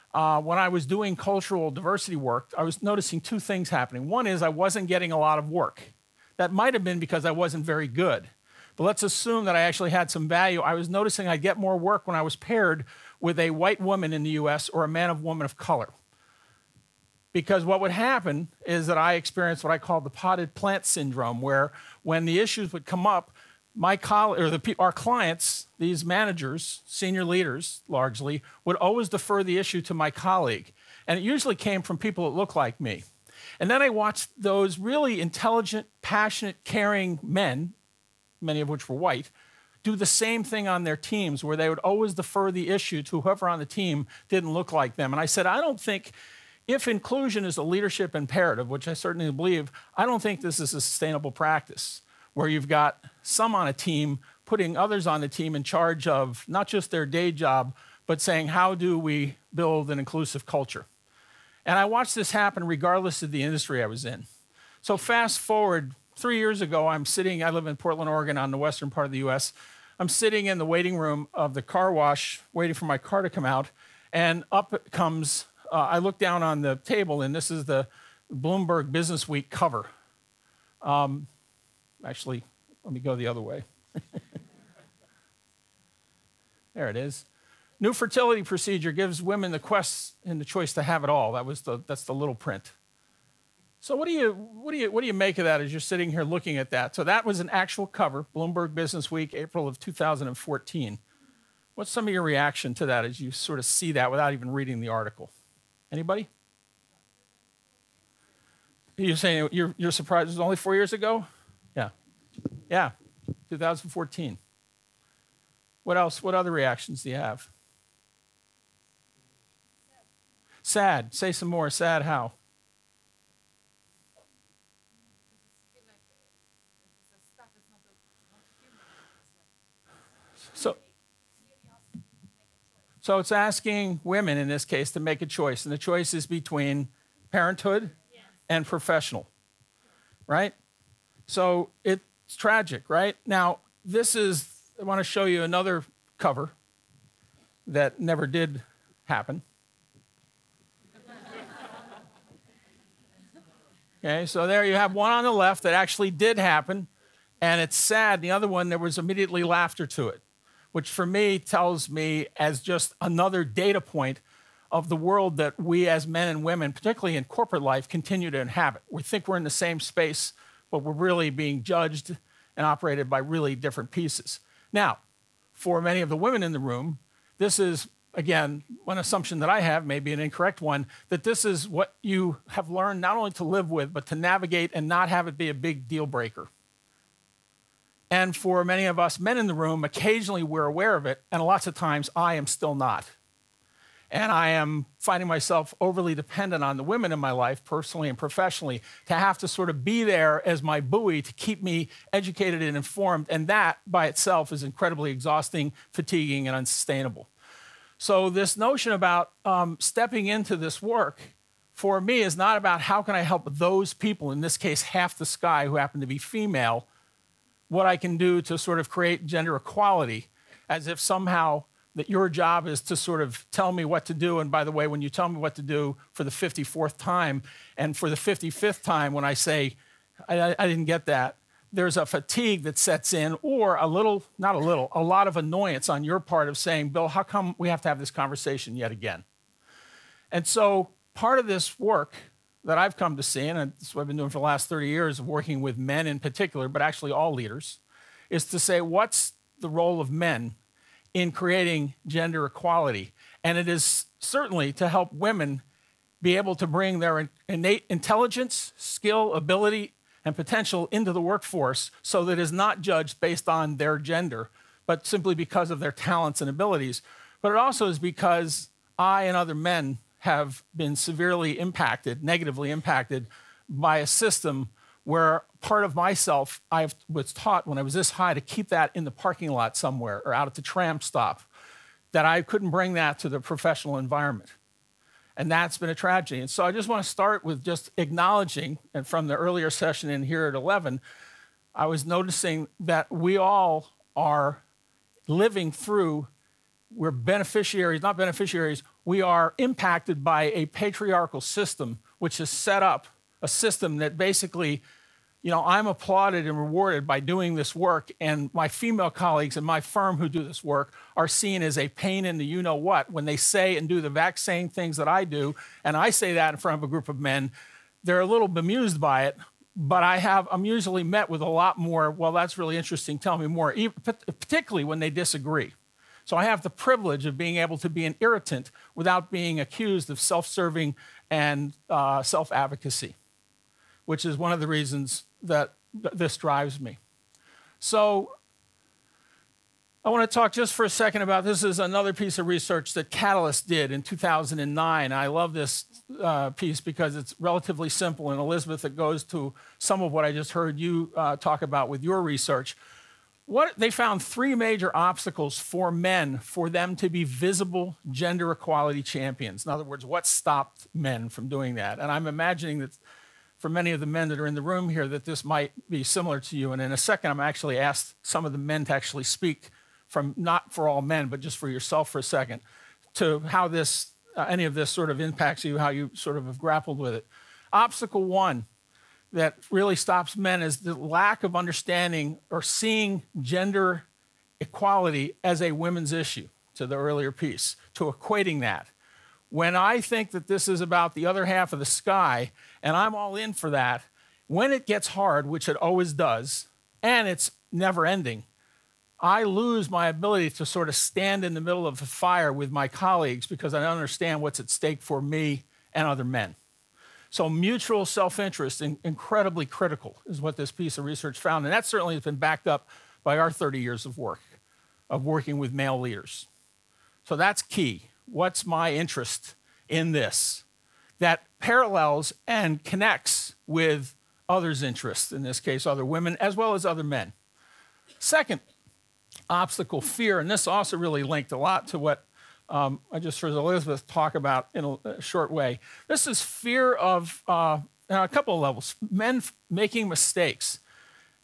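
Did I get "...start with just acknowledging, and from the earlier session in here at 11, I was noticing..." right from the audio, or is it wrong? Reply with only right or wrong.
right.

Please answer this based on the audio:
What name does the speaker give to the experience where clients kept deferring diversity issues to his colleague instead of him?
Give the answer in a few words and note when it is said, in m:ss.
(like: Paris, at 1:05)
potted plant syndrome, at 0:20.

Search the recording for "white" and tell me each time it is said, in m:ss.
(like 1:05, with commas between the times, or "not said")
0:13, 0:38.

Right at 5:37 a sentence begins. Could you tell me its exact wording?
So I want to talk just for a second about this is another piece of research that Catalyst did in 2009.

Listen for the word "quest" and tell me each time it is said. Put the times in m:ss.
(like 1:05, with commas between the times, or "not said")
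1:29.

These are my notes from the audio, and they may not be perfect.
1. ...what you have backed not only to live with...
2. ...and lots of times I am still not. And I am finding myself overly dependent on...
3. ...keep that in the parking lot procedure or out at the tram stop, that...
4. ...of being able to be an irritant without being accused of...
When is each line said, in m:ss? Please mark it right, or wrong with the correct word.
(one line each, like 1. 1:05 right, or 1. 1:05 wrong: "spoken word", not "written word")
1. 3:01 wrong: "learned", not "backed"
2. 3:11 right
3. 4:38 wrong: "somewhere", not "procedure"
4. 5:27 right.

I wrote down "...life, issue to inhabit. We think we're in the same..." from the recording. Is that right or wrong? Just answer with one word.
wrong.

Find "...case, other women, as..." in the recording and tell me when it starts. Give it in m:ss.
7:05.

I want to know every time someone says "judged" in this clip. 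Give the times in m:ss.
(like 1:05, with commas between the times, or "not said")
2:51, 4:22.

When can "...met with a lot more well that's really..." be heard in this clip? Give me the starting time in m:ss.
5:21.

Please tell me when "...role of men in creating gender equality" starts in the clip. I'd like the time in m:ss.
4:09.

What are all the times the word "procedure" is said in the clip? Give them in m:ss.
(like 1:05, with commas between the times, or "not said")
1:28.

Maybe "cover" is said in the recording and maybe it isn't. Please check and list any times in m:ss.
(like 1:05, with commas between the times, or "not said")
1:19, 1:37, 2:26.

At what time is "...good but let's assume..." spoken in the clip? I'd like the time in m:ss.
0:07.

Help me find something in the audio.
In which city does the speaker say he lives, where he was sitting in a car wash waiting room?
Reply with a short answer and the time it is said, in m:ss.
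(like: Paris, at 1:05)
Portland, Oregon, at 1:07.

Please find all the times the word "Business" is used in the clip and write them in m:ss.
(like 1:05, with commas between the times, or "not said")
1:18, 1:38.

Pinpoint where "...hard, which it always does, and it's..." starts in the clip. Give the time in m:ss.
6:35.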